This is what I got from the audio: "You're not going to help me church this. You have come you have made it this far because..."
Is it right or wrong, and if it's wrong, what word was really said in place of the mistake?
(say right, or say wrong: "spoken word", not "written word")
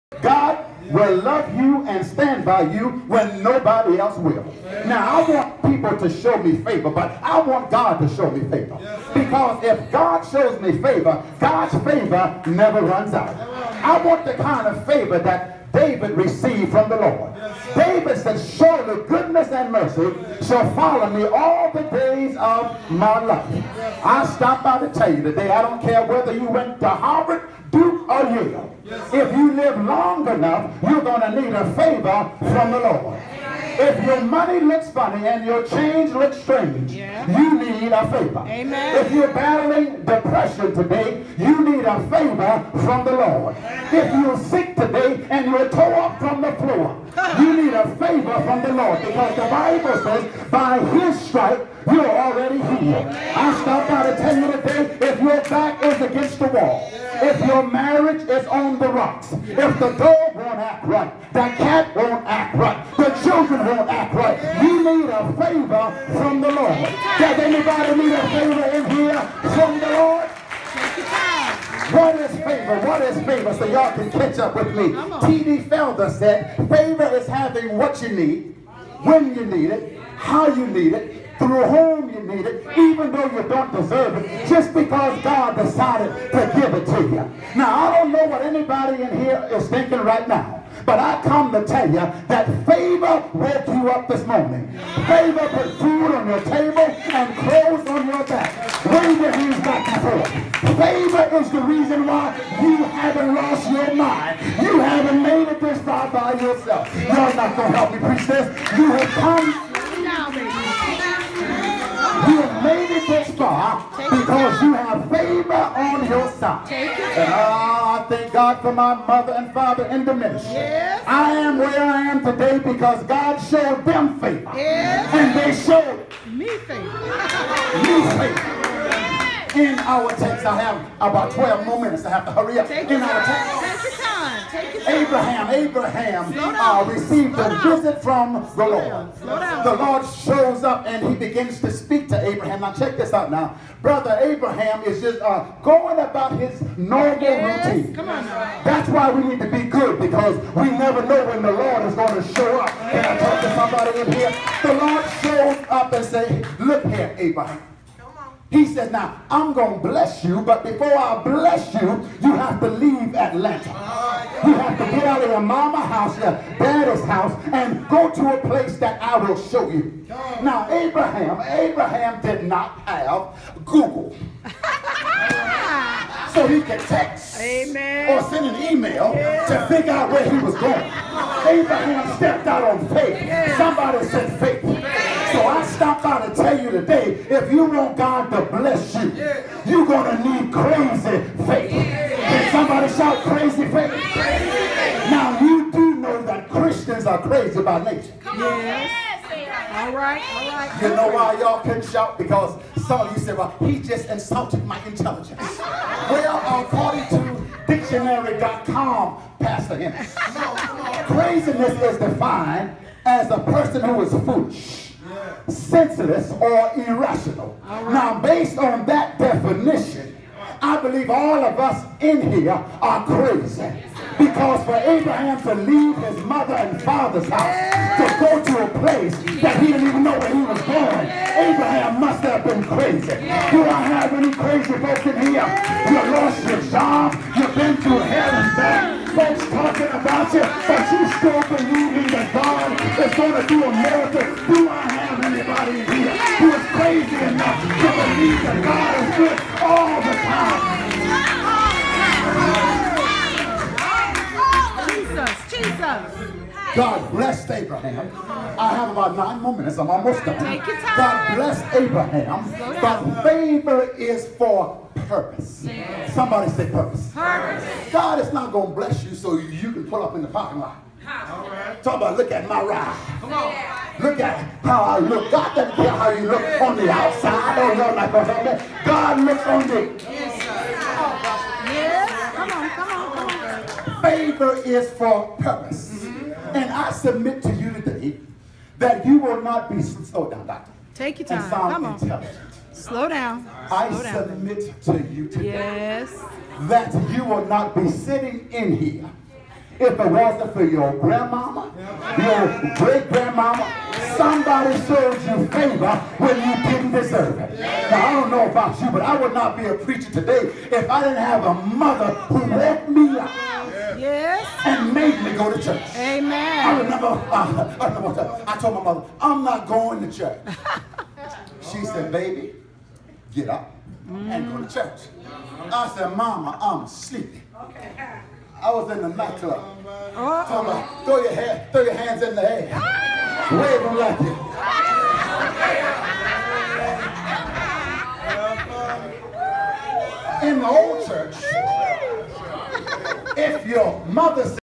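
wrong: "preach", not "church".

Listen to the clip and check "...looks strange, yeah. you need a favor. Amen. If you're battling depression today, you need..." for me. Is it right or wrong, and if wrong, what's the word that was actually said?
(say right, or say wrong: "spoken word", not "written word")
right.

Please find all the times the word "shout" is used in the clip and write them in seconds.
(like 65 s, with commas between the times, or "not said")
192 s, 201 s.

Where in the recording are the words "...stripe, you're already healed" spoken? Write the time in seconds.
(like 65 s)
51 s.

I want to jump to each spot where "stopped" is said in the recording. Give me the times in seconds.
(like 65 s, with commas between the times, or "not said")
24 s, 53 s.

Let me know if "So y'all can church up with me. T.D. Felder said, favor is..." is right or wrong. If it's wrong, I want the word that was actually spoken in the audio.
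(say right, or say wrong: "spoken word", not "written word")
wrong: "catch", not "church".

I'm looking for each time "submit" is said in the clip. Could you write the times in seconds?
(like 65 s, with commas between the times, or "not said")
287 s, 294 s.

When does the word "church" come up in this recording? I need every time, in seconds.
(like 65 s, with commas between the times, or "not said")
315 s, 320 s, 324 s, 341 s.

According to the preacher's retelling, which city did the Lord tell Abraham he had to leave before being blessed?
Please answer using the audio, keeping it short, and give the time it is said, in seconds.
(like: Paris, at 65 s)
Atlanta, at 163 s.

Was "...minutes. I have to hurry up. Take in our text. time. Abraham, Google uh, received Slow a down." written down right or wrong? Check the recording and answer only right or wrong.
wrong.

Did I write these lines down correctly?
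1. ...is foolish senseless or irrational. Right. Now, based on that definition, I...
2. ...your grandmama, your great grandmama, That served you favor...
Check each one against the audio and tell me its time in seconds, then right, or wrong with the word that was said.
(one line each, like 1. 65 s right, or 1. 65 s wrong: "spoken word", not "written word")
1. 214 s right
2. 300 s wrong: "Somebody", not "That".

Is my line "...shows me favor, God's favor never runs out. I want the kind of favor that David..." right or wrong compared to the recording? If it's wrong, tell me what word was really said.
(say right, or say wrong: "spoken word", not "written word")
right.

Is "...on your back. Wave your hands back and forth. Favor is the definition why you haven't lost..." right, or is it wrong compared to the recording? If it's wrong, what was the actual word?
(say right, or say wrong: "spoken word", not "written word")
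wrong: "reason", not "definition".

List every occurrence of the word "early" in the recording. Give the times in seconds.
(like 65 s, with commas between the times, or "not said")
not said.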